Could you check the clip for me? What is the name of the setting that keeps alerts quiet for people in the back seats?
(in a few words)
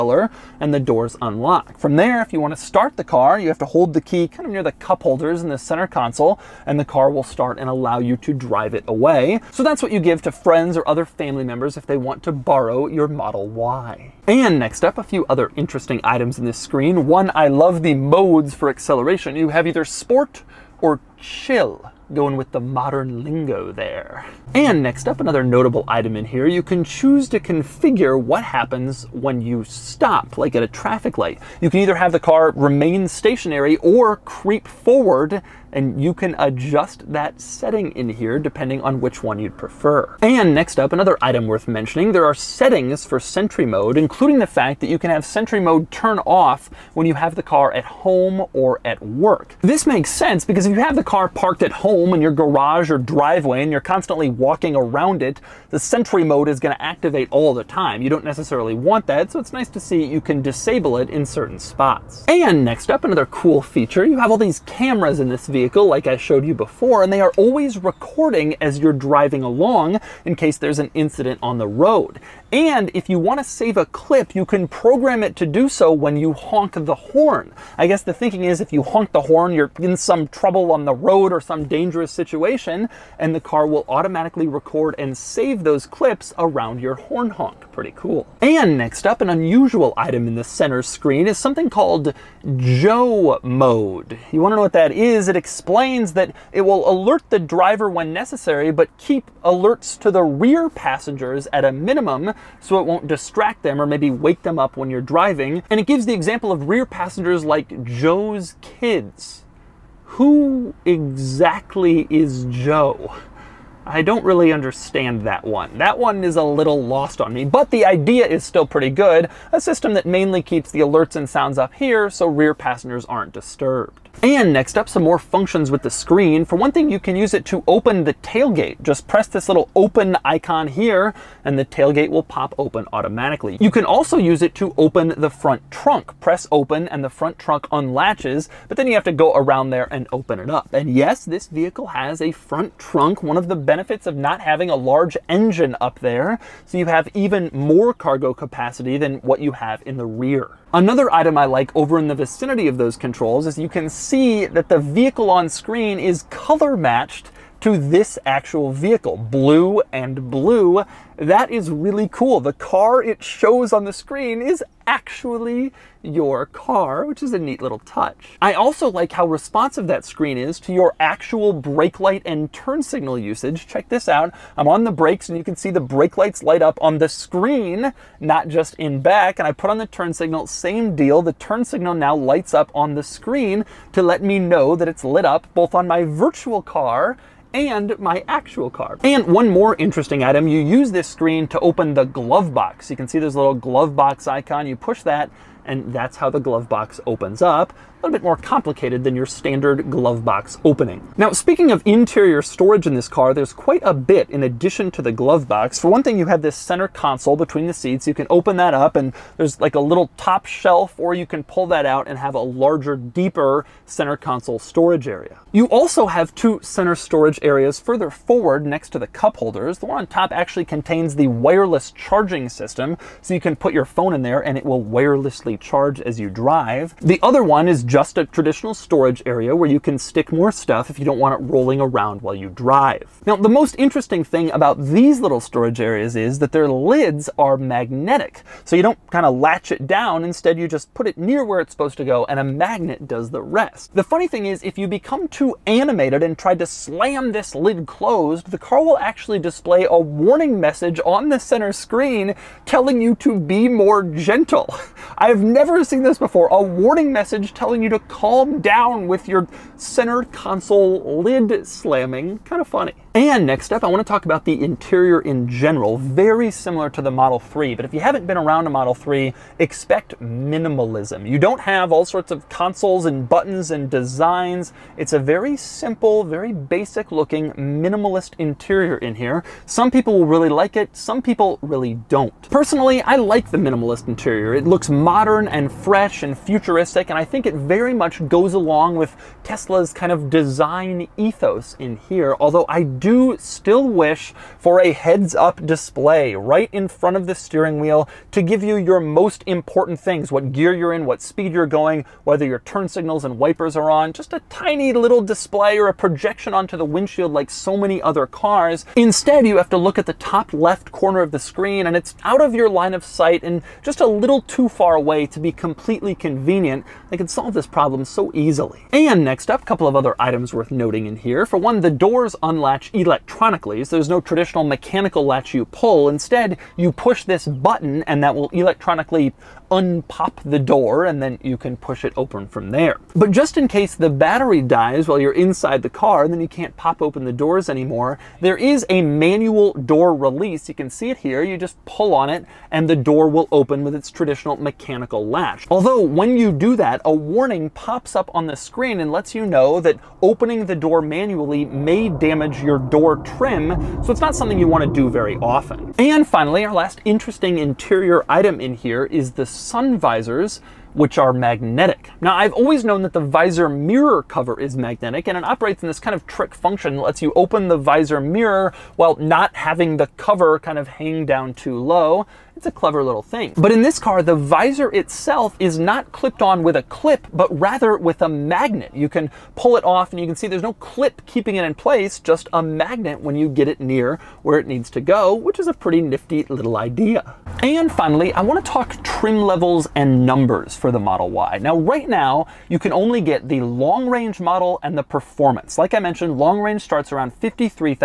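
Joe mode.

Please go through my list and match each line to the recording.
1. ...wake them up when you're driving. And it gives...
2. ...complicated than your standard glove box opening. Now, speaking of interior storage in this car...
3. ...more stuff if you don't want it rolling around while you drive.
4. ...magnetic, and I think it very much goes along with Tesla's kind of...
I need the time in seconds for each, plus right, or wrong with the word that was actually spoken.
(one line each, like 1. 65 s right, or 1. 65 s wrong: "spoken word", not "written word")
1. 104 s right
2. 198 s right
3. 230 s right
4. 286 s wrong: "futuristic", not "magnetic".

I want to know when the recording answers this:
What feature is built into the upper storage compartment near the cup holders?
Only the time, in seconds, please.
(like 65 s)
221 s.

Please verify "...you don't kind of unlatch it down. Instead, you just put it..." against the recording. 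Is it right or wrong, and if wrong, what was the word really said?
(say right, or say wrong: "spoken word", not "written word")
wrong: "latch", not "unlatch".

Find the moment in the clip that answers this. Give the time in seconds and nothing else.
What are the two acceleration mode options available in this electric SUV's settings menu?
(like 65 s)
19 s.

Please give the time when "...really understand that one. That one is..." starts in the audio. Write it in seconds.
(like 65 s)
114 s.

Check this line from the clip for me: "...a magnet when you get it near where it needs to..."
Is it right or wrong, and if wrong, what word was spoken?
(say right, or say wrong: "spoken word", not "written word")
right.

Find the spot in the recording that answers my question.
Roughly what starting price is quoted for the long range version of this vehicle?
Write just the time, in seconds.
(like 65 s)
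397 s.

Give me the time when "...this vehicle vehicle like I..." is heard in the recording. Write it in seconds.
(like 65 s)
65 s.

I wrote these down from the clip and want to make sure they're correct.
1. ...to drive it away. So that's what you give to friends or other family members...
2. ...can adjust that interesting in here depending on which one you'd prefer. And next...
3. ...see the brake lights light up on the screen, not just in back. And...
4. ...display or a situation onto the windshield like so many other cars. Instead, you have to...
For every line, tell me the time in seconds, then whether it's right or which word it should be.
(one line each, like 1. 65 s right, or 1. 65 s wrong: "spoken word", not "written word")
1. 8 s right
2. 36 s wrong: "setting", not "interesting"
3. 175 s right
4. 305 s wrong: "projection", not "situation".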